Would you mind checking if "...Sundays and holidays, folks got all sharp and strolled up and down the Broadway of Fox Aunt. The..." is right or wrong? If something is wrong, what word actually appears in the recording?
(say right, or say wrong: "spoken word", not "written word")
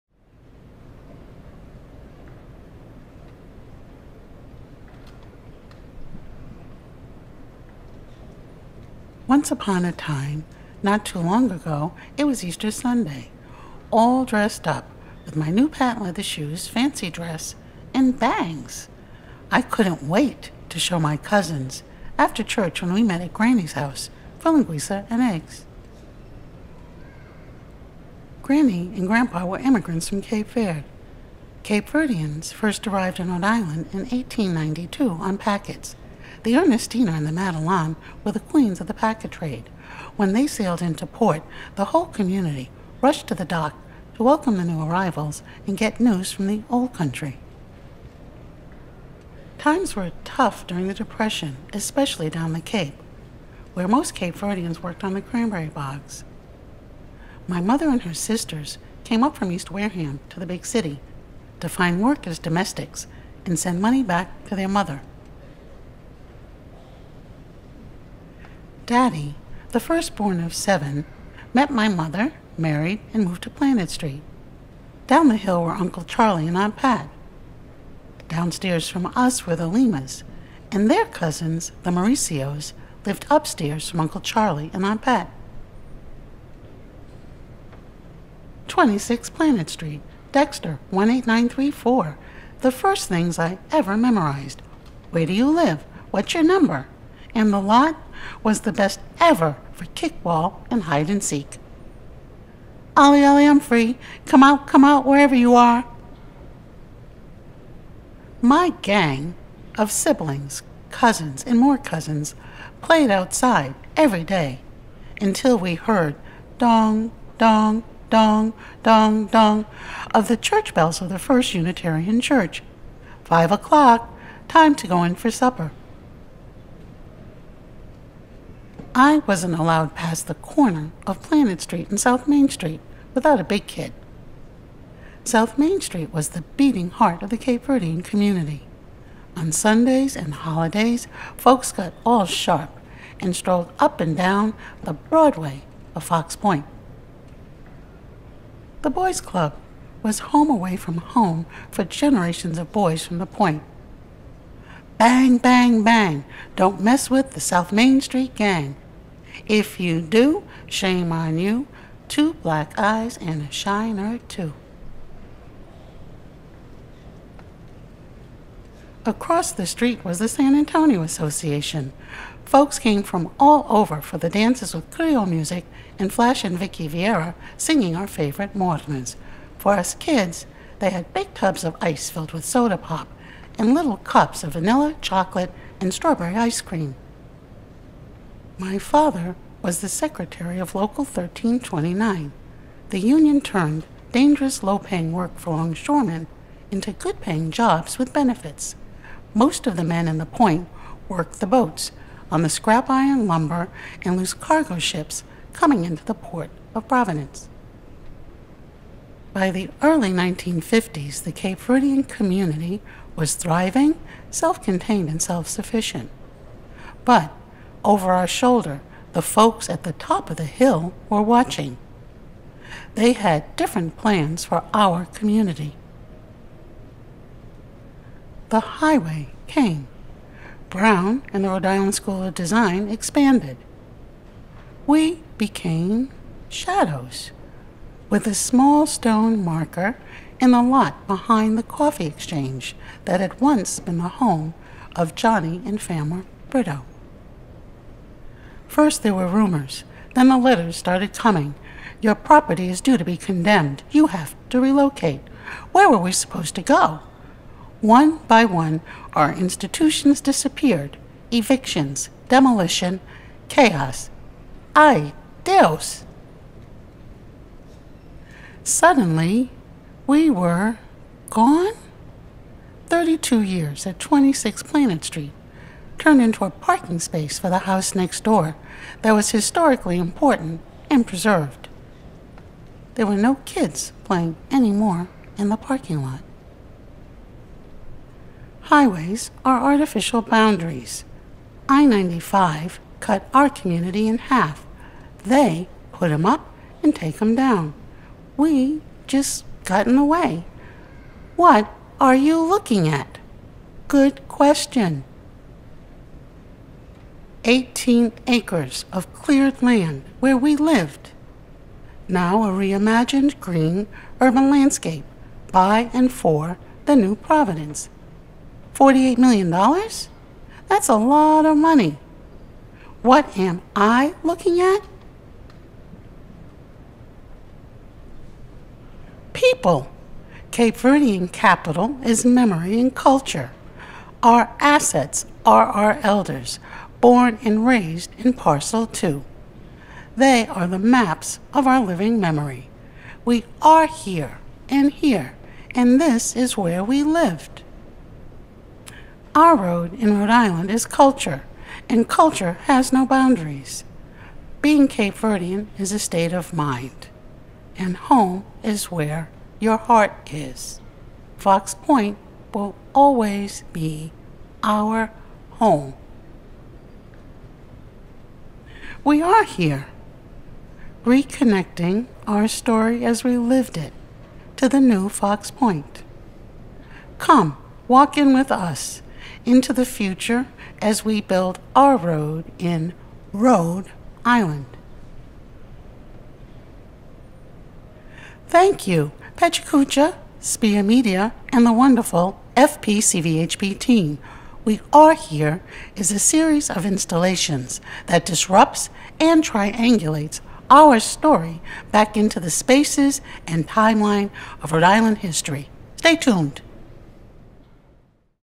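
wrong: "Point", not "Aunt".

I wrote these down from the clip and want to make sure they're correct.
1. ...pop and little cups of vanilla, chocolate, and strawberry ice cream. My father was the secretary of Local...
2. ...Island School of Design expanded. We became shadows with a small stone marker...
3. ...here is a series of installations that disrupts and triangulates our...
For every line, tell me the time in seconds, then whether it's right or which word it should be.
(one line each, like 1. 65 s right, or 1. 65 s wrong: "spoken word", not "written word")
1. 182 s right
2. 231 s right
3. 395 s right.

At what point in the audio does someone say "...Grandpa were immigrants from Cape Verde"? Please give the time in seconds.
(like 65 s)
29 s.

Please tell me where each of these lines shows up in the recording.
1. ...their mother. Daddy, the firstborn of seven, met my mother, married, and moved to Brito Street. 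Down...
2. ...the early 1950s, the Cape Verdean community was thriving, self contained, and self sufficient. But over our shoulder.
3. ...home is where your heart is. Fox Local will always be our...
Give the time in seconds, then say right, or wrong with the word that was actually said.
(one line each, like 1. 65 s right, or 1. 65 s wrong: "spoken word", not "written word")
1. 64 s wrong: "Planet", not "Brito"
2. 209 s right
3. 357 s wrong: "Point", not "Local".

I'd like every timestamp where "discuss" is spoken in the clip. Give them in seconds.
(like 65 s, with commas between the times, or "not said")
not said.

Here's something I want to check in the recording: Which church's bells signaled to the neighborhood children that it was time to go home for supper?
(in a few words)
First Unitarian Church.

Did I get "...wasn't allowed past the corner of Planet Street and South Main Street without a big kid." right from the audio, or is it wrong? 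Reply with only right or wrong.
right.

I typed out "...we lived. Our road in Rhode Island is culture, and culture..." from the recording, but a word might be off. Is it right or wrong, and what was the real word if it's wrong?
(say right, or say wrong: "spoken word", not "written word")
right.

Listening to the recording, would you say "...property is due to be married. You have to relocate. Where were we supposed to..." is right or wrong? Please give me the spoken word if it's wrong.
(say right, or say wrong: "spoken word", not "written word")
wrong: "condemned", not "married".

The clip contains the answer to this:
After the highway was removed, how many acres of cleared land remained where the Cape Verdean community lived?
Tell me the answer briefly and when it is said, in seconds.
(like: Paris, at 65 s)
18, at 307 s.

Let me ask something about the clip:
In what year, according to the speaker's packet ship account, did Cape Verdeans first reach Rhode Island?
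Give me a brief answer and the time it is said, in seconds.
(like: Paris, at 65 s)
1892, at 33 s.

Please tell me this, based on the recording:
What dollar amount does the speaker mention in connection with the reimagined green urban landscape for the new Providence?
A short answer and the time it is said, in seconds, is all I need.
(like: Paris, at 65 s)
$48 million, at 318 s.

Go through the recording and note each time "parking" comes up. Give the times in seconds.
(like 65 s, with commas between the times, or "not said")
276 s, 285 s.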